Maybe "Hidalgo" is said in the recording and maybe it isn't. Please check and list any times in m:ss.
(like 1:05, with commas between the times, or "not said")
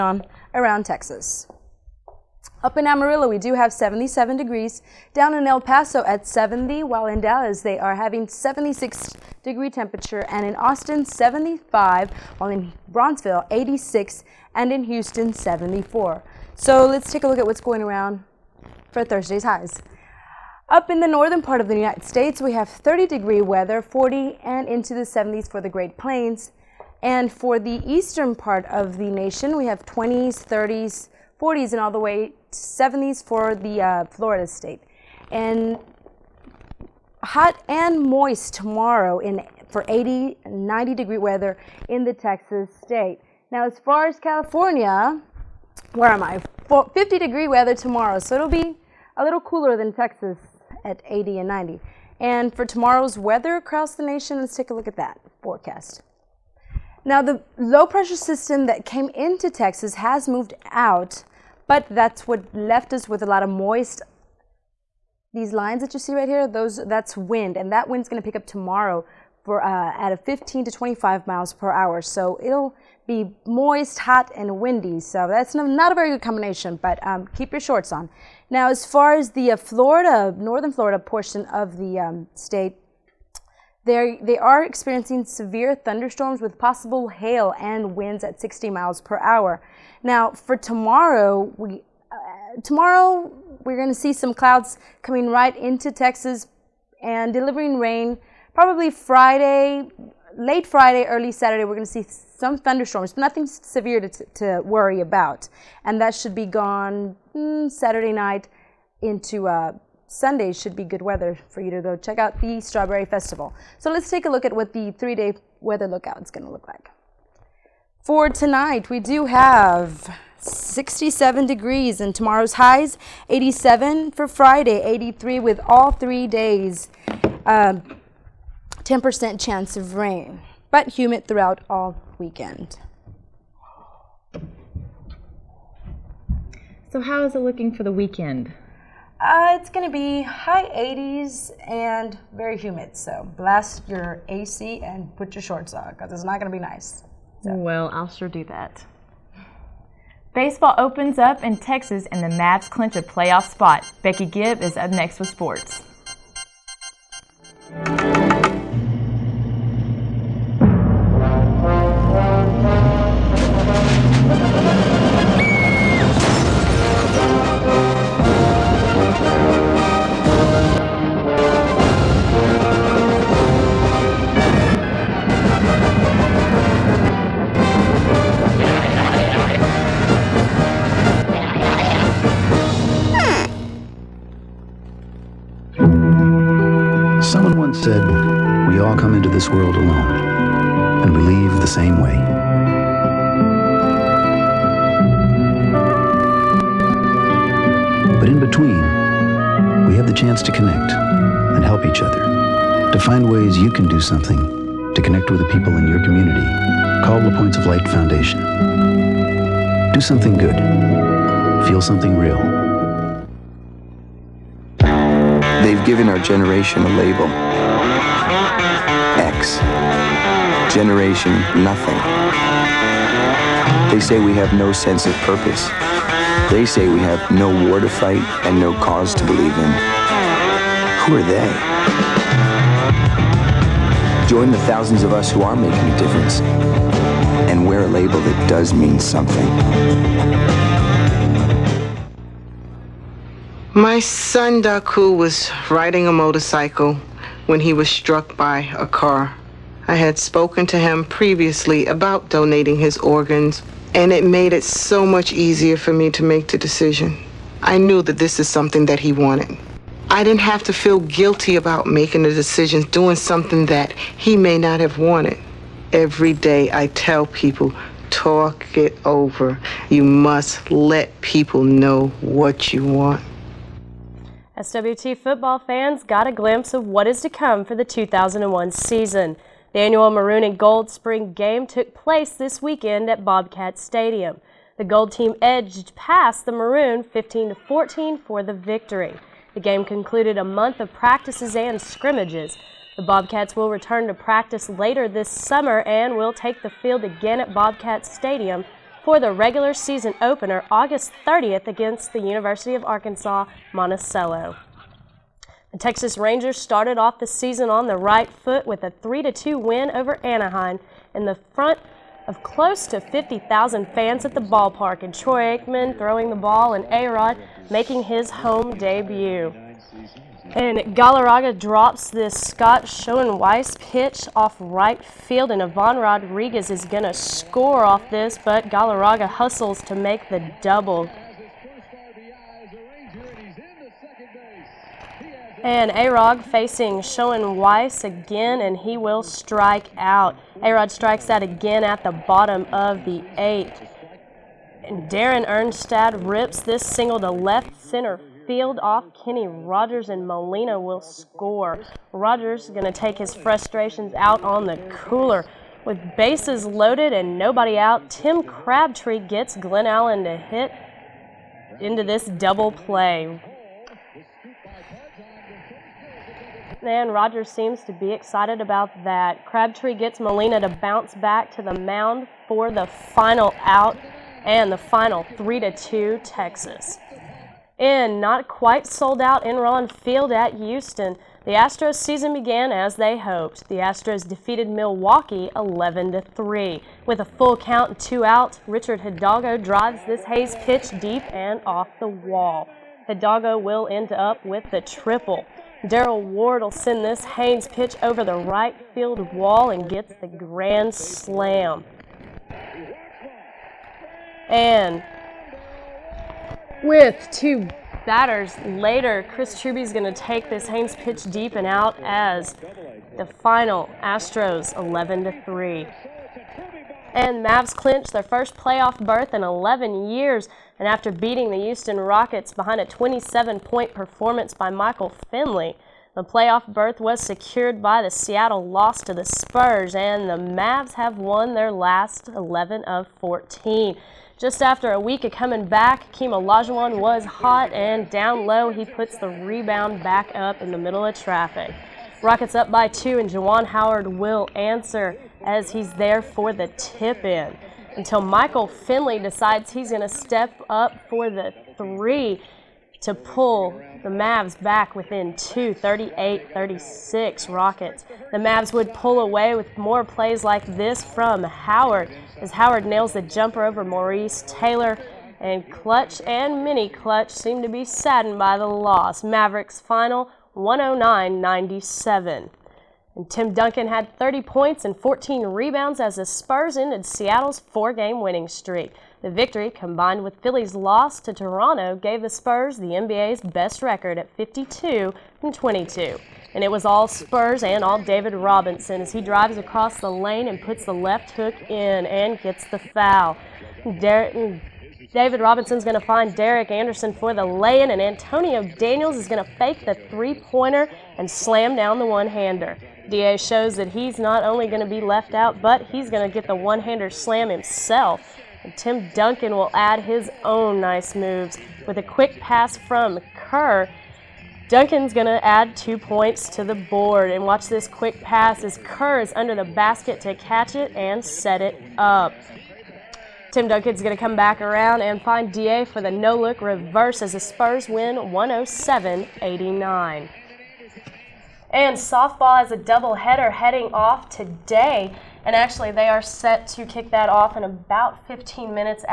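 6:29, 6:33.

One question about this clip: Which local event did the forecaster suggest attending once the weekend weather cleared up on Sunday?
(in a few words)
Strawberry Festival.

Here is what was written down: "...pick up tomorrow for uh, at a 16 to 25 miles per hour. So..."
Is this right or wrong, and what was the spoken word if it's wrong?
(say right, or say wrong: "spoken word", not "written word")
wrong: "15", not "16".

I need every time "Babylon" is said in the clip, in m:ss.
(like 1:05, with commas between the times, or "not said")
not said.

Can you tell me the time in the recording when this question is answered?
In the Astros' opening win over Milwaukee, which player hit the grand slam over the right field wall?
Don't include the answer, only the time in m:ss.
6:35.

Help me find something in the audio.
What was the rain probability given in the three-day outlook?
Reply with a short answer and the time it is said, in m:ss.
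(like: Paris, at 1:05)
10%, at 2:08.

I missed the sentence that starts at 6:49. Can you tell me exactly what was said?
Chris Truby's going to take this Haynes pitch deep and out as the final Astros 11 to 3.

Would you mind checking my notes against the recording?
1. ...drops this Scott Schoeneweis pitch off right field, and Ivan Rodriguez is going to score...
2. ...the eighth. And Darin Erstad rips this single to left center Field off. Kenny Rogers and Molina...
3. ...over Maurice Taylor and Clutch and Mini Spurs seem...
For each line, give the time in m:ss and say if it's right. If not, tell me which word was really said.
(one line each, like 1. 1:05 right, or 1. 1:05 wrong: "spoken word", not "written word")
1. 5:21 right
2. 5:43 right
3. 7:43 wrong: "Clutch", not "Spurs".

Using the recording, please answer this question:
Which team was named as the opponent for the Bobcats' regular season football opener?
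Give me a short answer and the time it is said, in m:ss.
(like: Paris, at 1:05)
University of Arkansas Monticello, at 5:02.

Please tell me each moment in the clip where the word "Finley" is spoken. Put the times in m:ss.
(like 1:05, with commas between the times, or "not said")
7:05, 7:28.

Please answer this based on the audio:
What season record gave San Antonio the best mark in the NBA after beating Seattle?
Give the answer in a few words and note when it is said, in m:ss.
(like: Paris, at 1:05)
52 and 22, at 8:04.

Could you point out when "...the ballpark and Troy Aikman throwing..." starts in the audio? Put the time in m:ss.
5:14.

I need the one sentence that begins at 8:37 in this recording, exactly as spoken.
And watch this quick pass as Kerr is under the basket to catch it and set it up.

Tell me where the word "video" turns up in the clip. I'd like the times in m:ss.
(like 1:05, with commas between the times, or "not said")
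not said.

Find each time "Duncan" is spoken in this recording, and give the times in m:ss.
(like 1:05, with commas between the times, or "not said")
7:53, 8:29, 8:34, 8:43.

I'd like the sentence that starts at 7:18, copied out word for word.
He puts the rebound back up in the middle of traffic.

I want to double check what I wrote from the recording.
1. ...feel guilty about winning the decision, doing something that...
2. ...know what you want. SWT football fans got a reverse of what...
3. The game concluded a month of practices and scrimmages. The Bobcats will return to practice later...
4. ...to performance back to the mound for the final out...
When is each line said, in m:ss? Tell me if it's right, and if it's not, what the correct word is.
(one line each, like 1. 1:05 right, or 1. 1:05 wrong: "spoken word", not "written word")
1. 4:20 wrong: "making", not "winning"
2. 4:31 wrong: "glimpse", not "reverse"
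3. 4:49 right
4. 6:10 wrong: "bounce", not "performance".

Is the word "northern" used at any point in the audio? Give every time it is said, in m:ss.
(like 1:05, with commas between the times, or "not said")
0:21, 1:20.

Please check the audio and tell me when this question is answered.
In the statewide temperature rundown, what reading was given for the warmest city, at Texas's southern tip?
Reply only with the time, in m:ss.
0:13.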